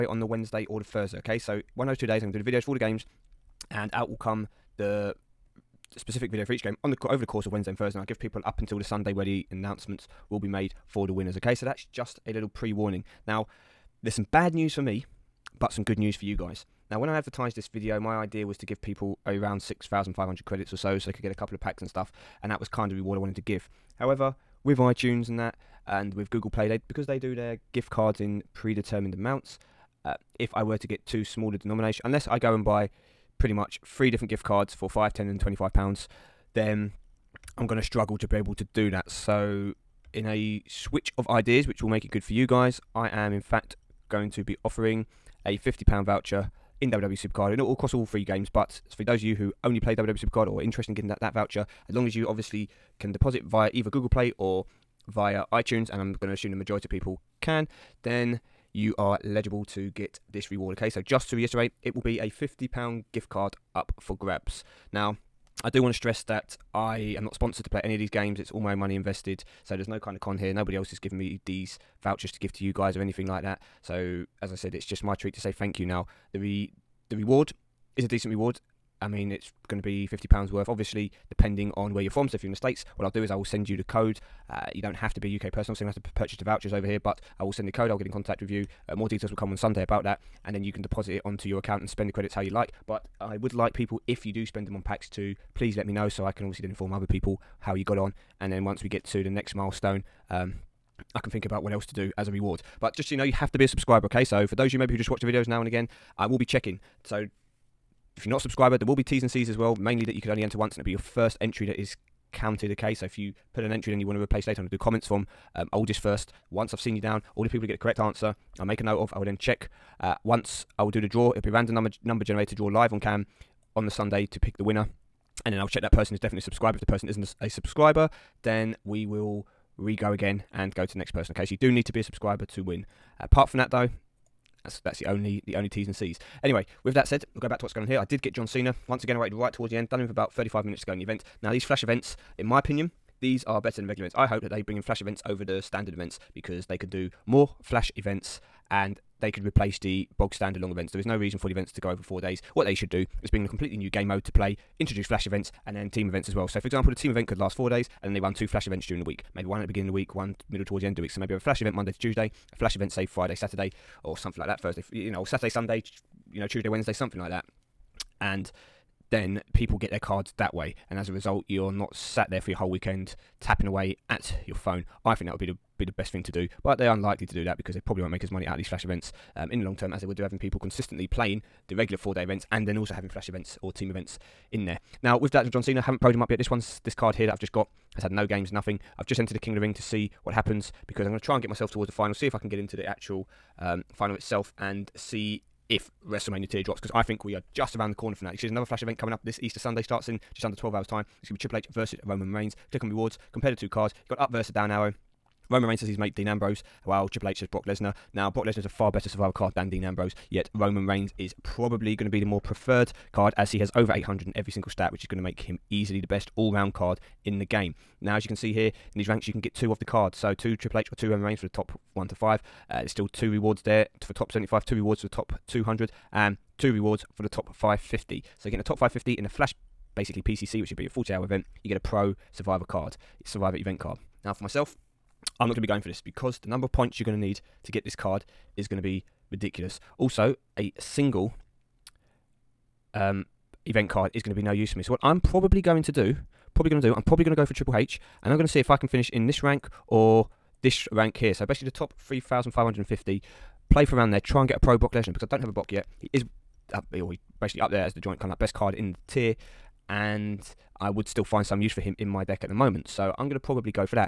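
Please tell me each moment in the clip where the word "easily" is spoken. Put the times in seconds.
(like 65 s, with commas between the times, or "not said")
215 s.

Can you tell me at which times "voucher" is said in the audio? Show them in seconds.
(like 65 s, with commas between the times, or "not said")
46 s, 51 s, 72 s, 86 s.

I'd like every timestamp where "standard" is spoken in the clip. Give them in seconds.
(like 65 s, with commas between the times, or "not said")
145 s, 150 s.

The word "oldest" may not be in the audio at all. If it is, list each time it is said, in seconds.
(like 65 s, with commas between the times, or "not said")
115 s.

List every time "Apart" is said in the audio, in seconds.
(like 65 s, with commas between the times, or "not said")
133 s.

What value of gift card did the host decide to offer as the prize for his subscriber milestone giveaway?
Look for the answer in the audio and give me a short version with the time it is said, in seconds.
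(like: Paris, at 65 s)
£50, at 45 s.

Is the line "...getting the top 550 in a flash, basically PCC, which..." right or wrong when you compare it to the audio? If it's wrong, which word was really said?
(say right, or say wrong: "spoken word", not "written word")
right.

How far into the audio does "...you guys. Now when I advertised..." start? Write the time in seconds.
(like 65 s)
16 s.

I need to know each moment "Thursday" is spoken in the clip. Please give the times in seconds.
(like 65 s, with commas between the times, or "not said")
0 s, 7 s, 164 s.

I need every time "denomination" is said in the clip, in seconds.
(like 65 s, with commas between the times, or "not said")
31 s.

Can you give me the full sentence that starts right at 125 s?
And then I'll check that person is definitely subscribed.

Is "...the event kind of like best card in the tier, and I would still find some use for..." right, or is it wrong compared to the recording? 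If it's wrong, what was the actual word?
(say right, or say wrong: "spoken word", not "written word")
wrong: "joint", not "event".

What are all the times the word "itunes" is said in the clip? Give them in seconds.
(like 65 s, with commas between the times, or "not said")
24 s, 55 s.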